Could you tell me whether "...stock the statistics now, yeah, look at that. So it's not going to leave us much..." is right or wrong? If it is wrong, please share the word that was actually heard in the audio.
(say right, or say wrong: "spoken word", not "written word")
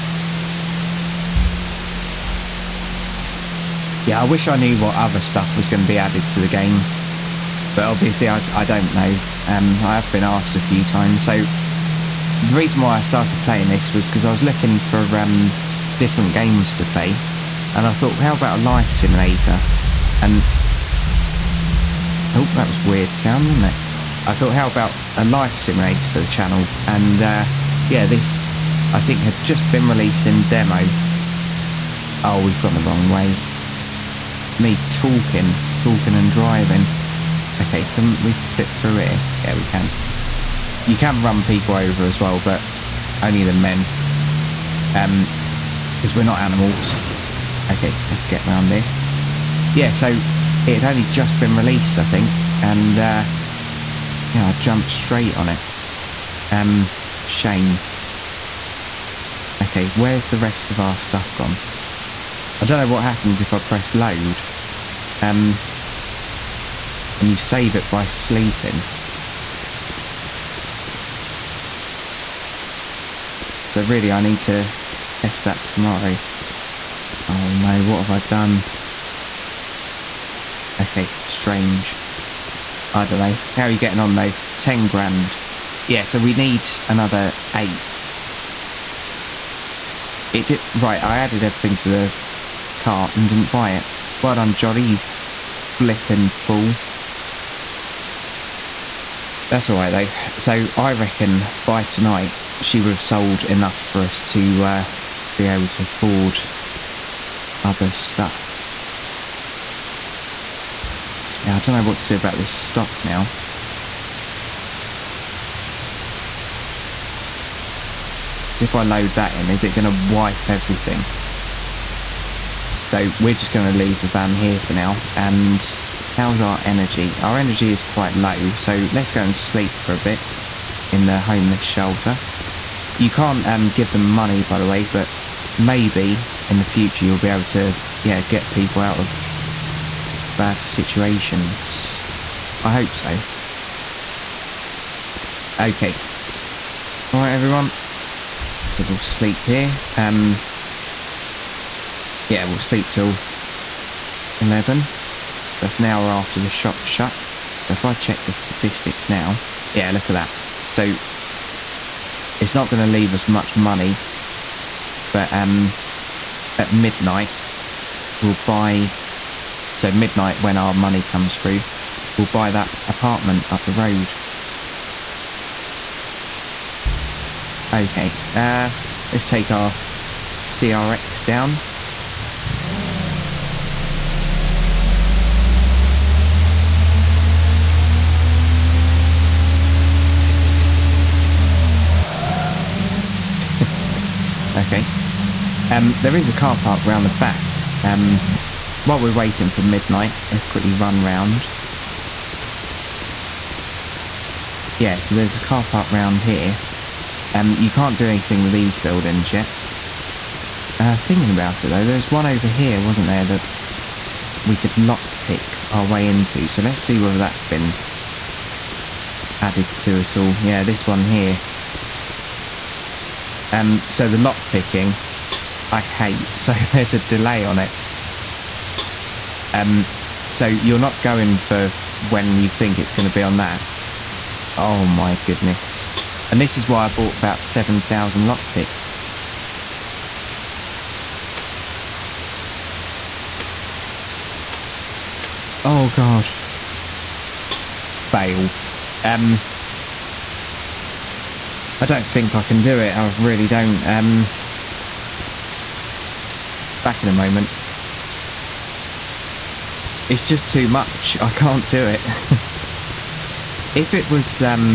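wrong: "check", not "stock".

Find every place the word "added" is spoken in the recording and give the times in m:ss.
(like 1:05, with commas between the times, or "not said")
0:05, 1:31, 3:39.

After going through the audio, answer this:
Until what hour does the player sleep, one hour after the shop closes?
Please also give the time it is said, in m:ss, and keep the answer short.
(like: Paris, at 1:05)
11, at 2:34.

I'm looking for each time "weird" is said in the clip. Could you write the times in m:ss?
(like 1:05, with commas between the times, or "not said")
0:22.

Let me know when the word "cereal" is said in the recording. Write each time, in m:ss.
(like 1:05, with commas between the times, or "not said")
not said.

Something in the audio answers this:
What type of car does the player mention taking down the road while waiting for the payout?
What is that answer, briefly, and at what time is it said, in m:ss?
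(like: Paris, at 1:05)
CRX, at 3:00.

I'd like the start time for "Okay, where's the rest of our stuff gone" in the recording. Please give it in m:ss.
0:59.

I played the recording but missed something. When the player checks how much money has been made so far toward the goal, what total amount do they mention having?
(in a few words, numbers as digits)
10 grand.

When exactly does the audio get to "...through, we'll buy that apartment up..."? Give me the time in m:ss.
2:51.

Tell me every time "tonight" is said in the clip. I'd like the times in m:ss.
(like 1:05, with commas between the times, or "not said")
1:41.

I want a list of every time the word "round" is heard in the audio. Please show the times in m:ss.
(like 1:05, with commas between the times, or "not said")
0:48, 3:16, 3:21, 3:25.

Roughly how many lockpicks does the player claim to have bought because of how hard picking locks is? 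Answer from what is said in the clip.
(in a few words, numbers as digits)
7,000.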